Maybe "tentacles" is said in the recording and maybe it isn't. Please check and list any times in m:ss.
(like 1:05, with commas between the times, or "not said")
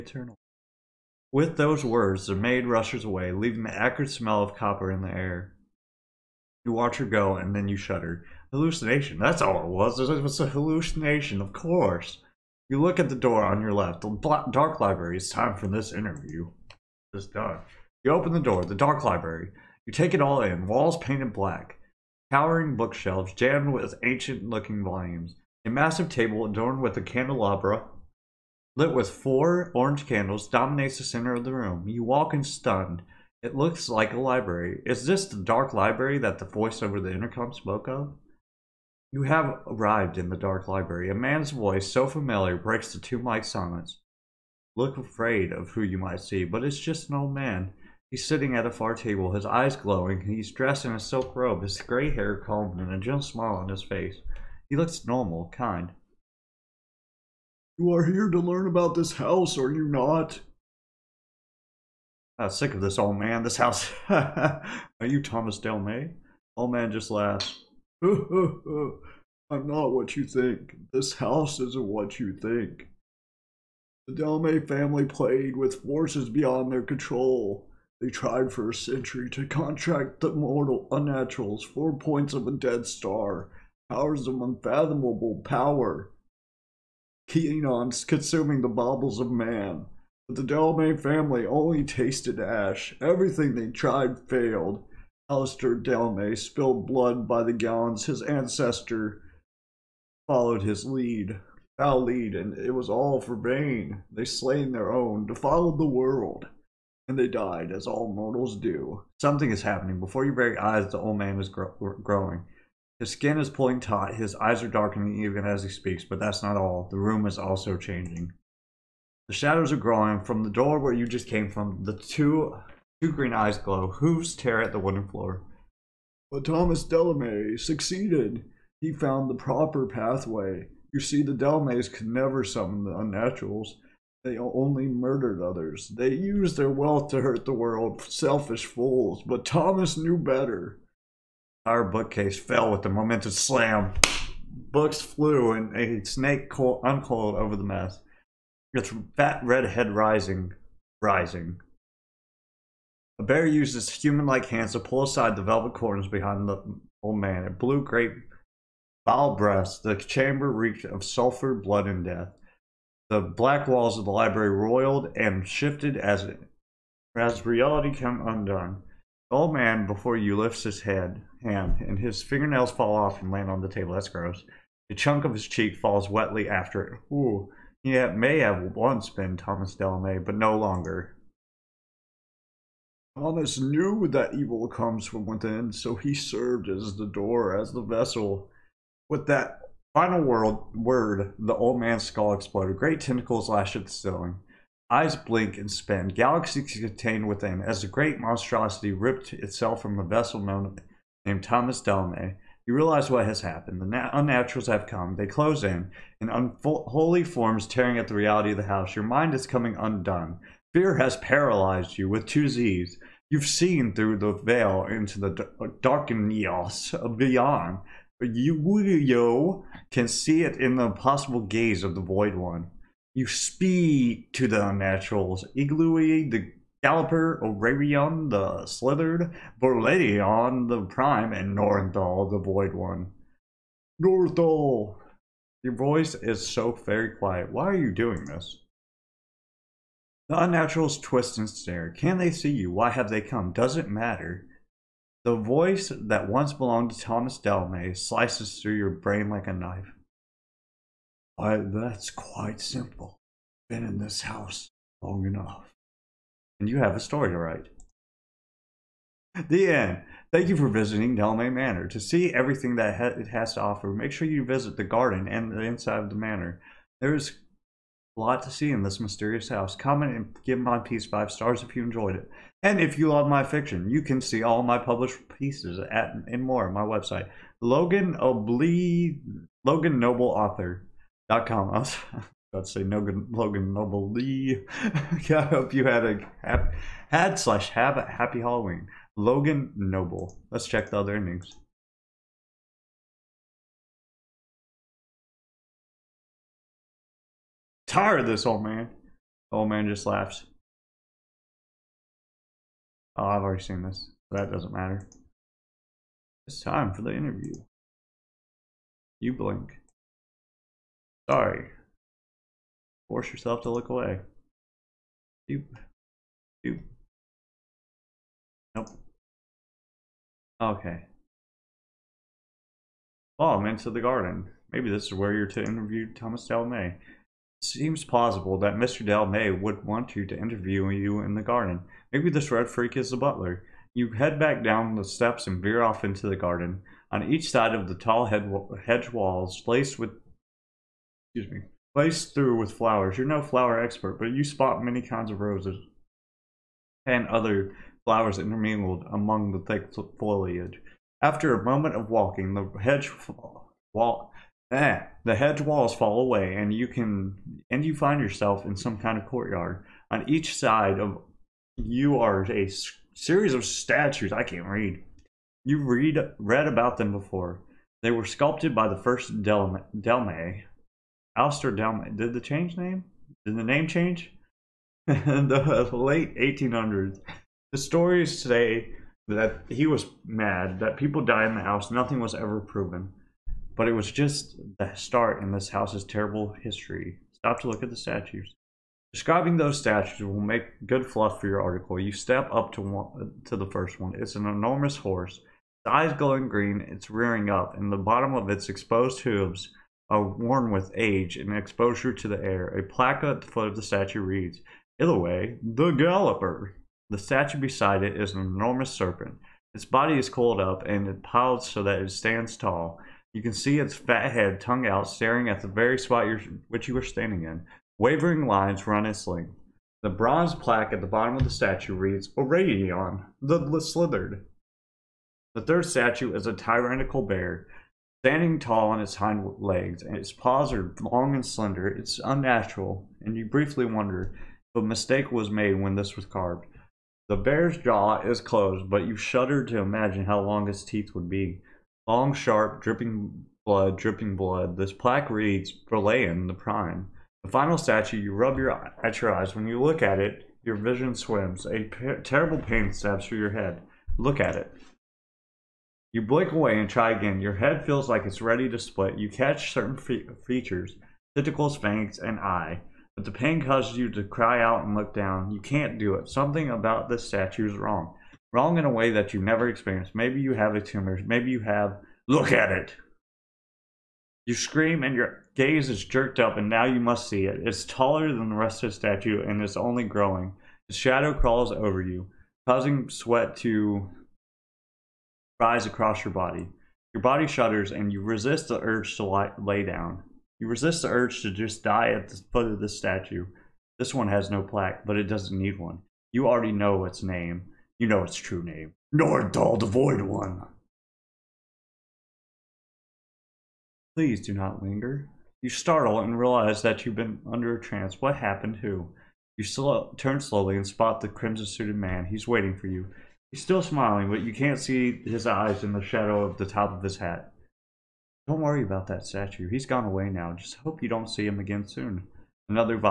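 3:12, 7:41.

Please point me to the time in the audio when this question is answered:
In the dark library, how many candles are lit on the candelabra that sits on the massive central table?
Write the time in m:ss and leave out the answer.
0:29.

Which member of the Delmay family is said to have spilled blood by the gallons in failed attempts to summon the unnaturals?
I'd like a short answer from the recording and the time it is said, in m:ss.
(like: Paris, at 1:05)
Alistair Dalmay, at 1:35.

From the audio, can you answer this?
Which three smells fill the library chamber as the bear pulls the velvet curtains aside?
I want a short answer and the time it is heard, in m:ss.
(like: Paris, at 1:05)
Sulfur, blood, and death, at 2:41.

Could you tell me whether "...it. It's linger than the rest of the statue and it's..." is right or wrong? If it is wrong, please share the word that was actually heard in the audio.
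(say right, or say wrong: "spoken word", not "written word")
wrong: "taller", not "linger".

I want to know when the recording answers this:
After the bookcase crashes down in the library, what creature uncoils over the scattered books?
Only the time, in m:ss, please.
2:25.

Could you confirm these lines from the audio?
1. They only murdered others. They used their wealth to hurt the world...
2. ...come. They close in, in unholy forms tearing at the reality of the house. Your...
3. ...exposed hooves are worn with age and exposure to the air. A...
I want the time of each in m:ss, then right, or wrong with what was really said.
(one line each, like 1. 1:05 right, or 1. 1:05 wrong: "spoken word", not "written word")
1. 2:14 right
2. 3:24 right
3. 6:38 right.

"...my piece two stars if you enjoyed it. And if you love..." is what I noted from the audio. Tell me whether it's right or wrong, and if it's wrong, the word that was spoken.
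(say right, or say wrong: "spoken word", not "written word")
wrong: "five", not "two".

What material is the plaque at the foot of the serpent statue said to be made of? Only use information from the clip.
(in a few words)
Bronze.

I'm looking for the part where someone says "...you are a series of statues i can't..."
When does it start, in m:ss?
6:01.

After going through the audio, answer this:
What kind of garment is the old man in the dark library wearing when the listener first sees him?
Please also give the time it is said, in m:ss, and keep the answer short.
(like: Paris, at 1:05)
A silk robe, at 0:50.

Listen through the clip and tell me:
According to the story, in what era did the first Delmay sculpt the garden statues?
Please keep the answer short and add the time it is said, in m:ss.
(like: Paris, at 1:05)
The late 1800s, at 6:15.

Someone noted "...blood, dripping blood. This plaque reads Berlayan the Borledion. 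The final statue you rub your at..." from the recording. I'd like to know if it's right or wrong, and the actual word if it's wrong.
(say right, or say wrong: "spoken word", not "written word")
wrong: "Prime", not "Borledion".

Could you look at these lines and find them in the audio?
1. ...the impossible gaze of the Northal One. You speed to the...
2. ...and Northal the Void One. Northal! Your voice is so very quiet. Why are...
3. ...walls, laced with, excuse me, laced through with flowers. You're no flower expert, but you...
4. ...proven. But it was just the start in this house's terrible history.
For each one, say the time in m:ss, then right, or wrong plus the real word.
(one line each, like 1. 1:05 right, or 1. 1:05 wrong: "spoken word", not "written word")
1. 3:40 wrong: "Void", not "Northal"
2. 3:51 right
3. 5:39 right
4. 6:22 right.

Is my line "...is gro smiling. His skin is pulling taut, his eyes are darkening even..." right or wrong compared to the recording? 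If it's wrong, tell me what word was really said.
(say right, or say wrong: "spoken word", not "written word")
wrong: "growing", not "smiling".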